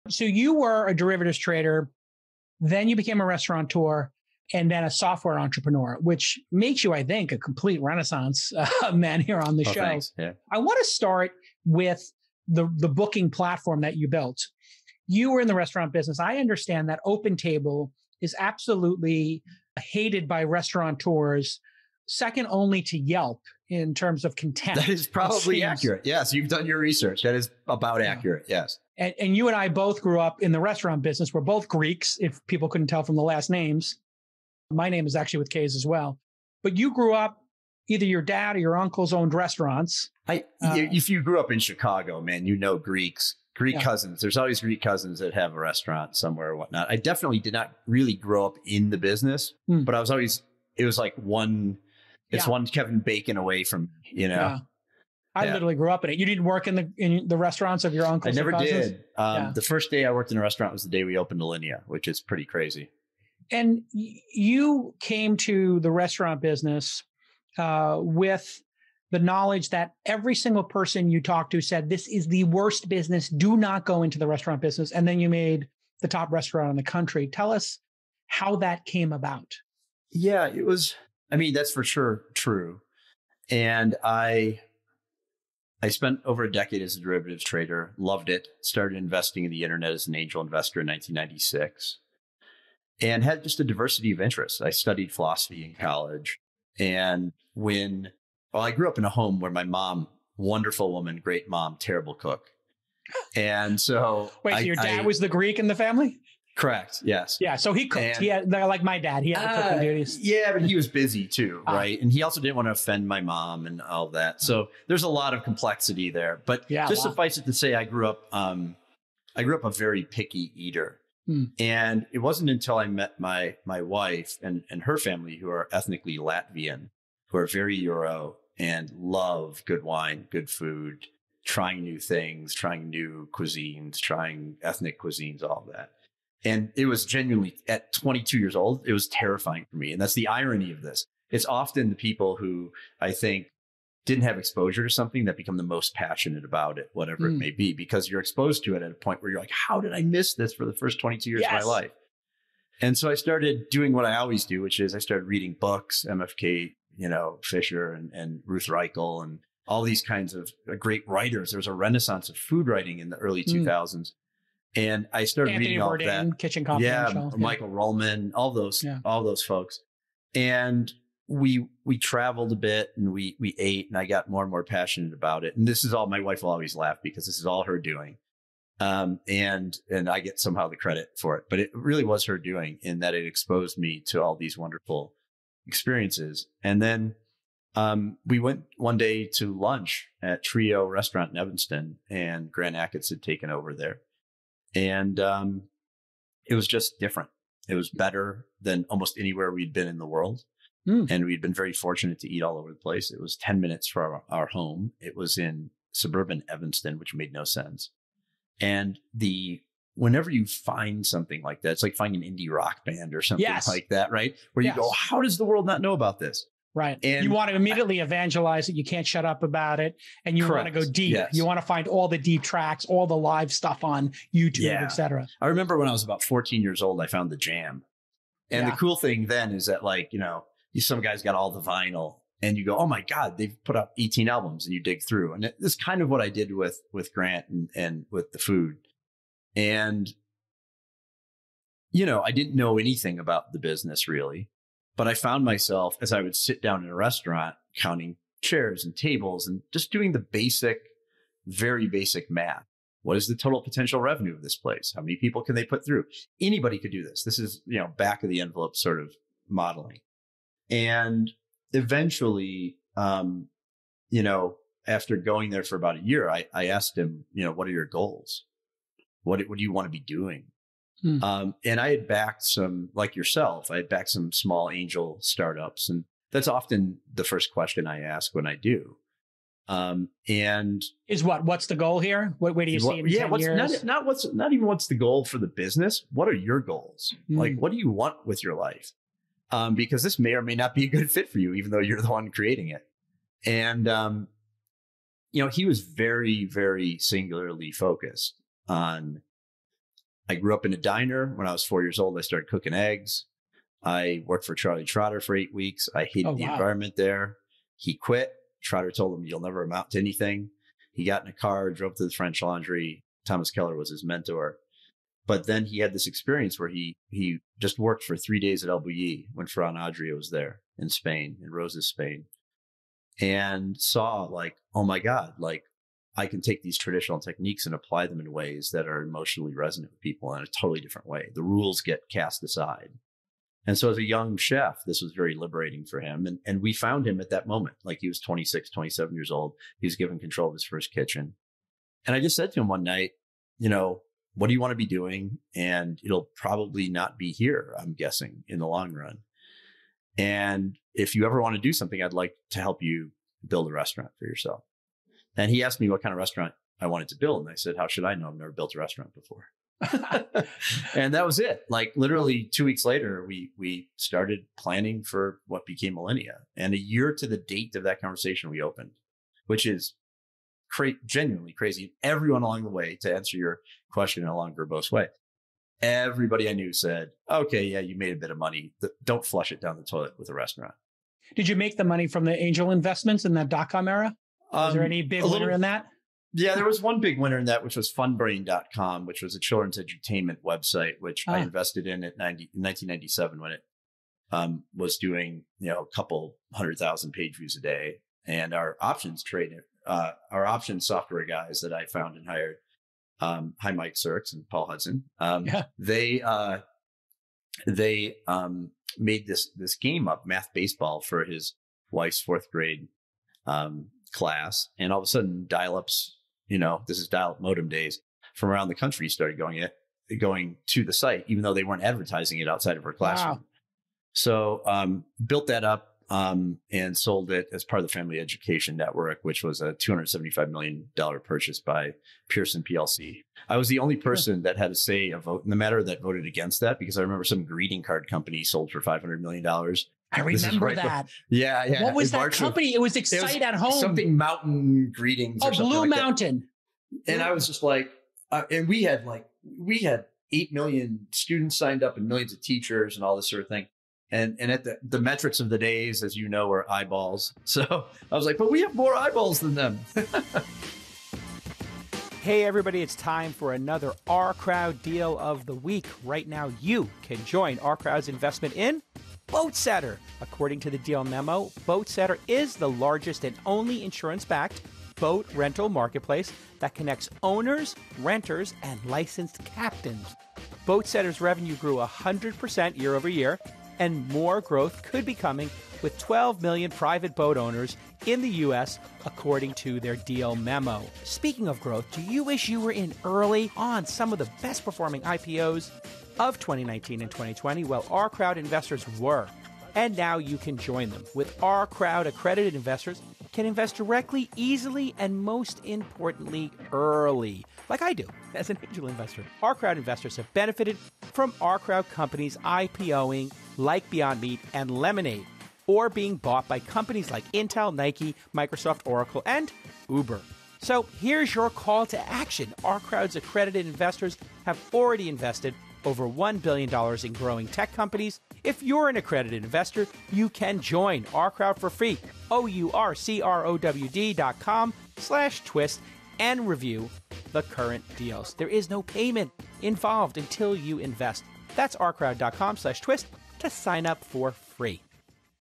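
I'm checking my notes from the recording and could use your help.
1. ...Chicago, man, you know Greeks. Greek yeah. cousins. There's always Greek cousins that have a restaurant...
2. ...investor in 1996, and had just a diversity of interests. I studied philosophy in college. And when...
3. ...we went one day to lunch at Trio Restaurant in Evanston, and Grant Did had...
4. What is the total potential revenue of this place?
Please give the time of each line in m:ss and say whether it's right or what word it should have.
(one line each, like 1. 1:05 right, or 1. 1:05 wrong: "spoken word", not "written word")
1. 0:41 right
2. 1:30 right
3. 3:08 wrong: "Achatz", not "Did"
4. 4:13 right.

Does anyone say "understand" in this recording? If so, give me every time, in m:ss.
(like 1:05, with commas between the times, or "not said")
0:16.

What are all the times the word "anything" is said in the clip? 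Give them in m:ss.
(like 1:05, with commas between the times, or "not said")
4:02, 5:09.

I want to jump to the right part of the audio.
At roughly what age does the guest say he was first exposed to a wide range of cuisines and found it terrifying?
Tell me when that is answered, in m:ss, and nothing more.
2:17.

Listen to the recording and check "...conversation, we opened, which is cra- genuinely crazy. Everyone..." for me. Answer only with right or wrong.
right.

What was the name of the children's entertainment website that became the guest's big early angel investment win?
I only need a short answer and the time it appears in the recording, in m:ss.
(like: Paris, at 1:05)
funbrain.com, at 6:27.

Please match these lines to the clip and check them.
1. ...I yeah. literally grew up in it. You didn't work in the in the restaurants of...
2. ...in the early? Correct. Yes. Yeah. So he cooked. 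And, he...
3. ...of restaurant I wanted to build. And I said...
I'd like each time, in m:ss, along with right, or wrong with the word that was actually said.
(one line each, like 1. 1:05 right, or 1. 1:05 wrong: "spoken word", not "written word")
1. 0:55 right
2. 1:45 wrong: "family", not "early"
3. 5:56 right.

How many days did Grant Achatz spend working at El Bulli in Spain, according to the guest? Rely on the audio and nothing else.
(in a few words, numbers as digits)
3.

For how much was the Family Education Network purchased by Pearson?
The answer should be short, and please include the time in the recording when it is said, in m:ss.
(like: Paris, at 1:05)
$275 million, at 7:09.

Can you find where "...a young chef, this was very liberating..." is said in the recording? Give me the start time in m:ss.
5:33.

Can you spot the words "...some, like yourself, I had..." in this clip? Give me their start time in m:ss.
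4:32.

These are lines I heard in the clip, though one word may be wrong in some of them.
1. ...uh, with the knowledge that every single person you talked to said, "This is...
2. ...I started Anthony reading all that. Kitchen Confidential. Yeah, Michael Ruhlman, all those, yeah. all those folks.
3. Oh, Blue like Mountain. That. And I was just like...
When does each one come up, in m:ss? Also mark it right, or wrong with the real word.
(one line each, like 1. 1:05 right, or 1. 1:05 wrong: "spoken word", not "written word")
1. 1:07 right
2. 2:45 right
3. 7:25 right.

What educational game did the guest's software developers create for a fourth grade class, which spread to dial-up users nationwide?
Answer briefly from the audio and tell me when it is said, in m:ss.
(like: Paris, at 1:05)
math baseball, at 6:50.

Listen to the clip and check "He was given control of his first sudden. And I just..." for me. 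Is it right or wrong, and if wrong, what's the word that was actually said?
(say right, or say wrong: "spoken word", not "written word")
wrong: "kitchen", not "sudden".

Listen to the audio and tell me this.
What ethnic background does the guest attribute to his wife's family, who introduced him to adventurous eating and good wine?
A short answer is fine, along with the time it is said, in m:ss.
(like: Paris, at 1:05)
Latvian, at 2:06.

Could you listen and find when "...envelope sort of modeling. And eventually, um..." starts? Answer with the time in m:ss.
4:18.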